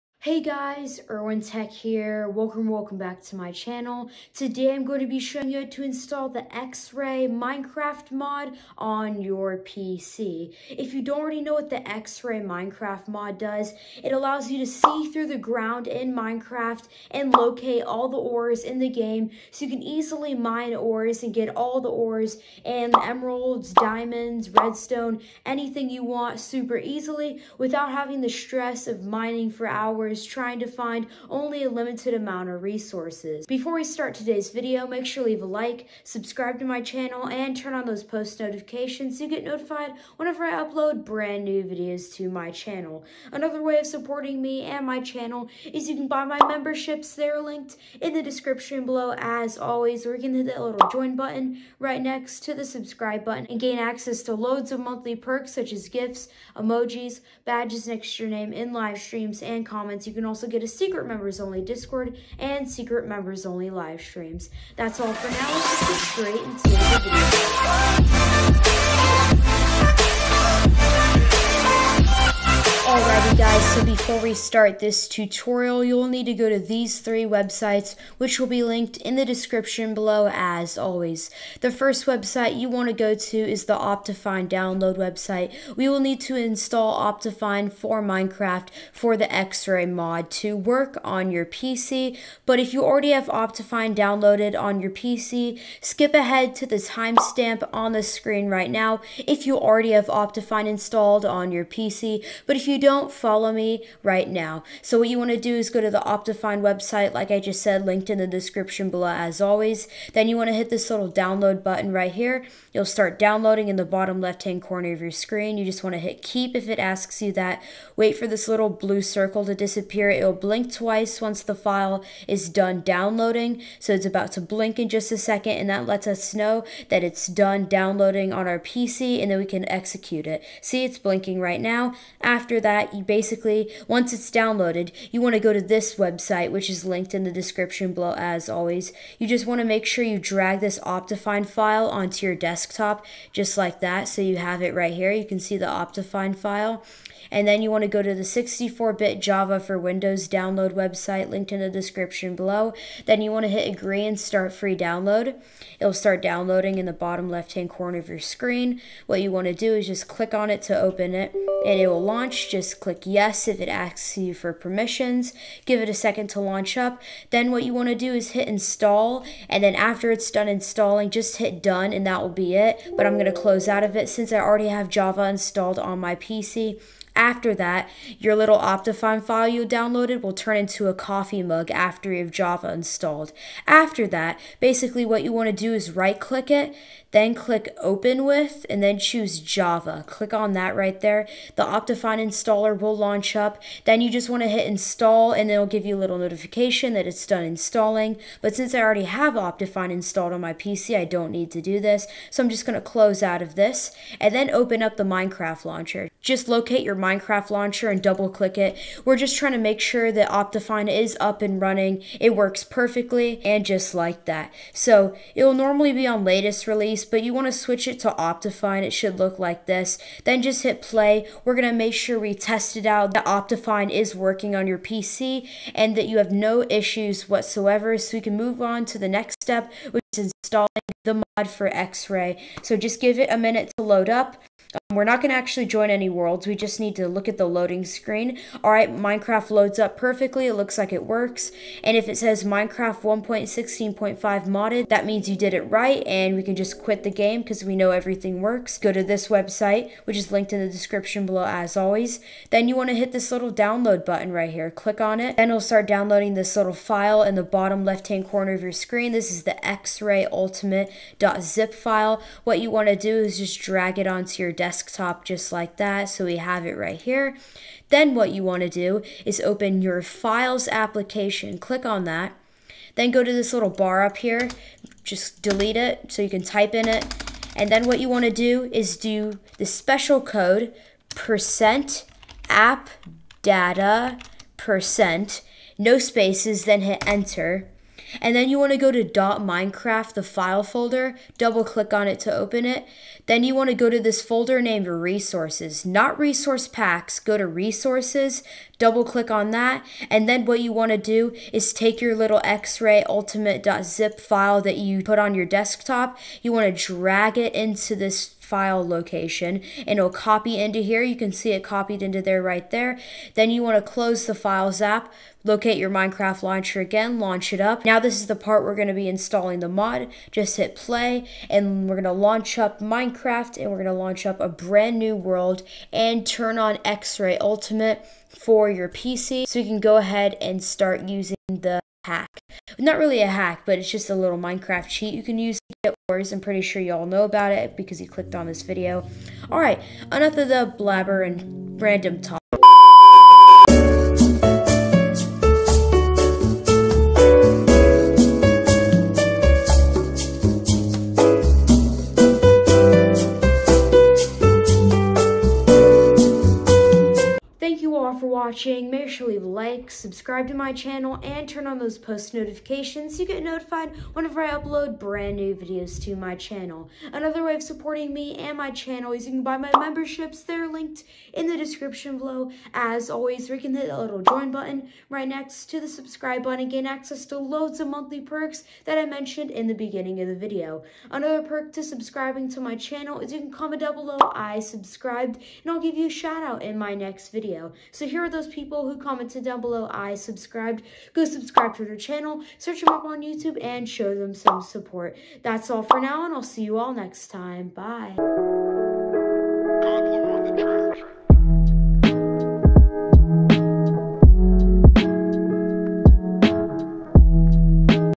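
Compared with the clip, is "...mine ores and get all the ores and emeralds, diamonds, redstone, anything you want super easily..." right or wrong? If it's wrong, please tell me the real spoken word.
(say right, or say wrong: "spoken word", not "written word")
right.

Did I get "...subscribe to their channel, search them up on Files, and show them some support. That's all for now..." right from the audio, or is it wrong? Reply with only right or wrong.
wrong.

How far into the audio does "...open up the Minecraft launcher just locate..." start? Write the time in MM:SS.
03:24.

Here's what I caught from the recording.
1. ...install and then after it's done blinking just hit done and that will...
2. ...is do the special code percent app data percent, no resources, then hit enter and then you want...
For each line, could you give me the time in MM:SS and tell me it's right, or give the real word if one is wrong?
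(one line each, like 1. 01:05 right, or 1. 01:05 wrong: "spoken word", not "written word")
1. 02:48 wrong: "installing", not "blinking"
2. 04:38 wrong: "spaces", not "resources".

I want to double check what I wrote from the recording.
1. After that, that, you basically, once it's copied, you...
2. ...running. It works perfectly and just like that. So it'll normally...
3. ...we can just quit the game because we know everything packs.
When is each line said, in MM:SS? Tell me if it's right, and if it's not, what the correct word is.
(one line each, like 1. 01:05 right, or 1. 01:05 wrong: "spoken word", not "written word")
1. 02:12 wrong: "downloaded", not "copied"
2. 03:31 right
3. 04:06 wrong: "works", not "packs".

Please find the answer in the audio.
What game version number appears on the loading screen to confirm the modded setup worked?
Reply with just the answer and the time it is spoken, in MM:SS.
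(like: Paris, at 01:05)
1.16.5, at 04:03.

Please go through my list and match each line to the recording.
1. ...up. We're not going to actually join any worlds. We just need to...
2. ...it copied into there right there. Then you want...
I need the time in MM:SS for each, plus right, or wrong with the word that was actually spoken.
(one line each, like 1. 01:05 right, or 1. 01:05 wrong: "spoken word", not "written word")
1. 03:54 right
2. 05:11 right.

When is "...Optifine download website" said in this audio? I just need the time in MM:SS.
01:23.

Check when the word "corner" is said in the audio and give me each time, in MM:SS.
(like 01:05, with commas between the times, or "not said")
01:54, 02:37, 04:18.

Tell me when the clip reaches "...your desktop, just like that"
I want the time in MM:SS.
02:22.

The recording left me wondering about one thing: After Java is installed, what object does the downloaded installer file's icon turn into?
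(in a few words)
a coffee mug.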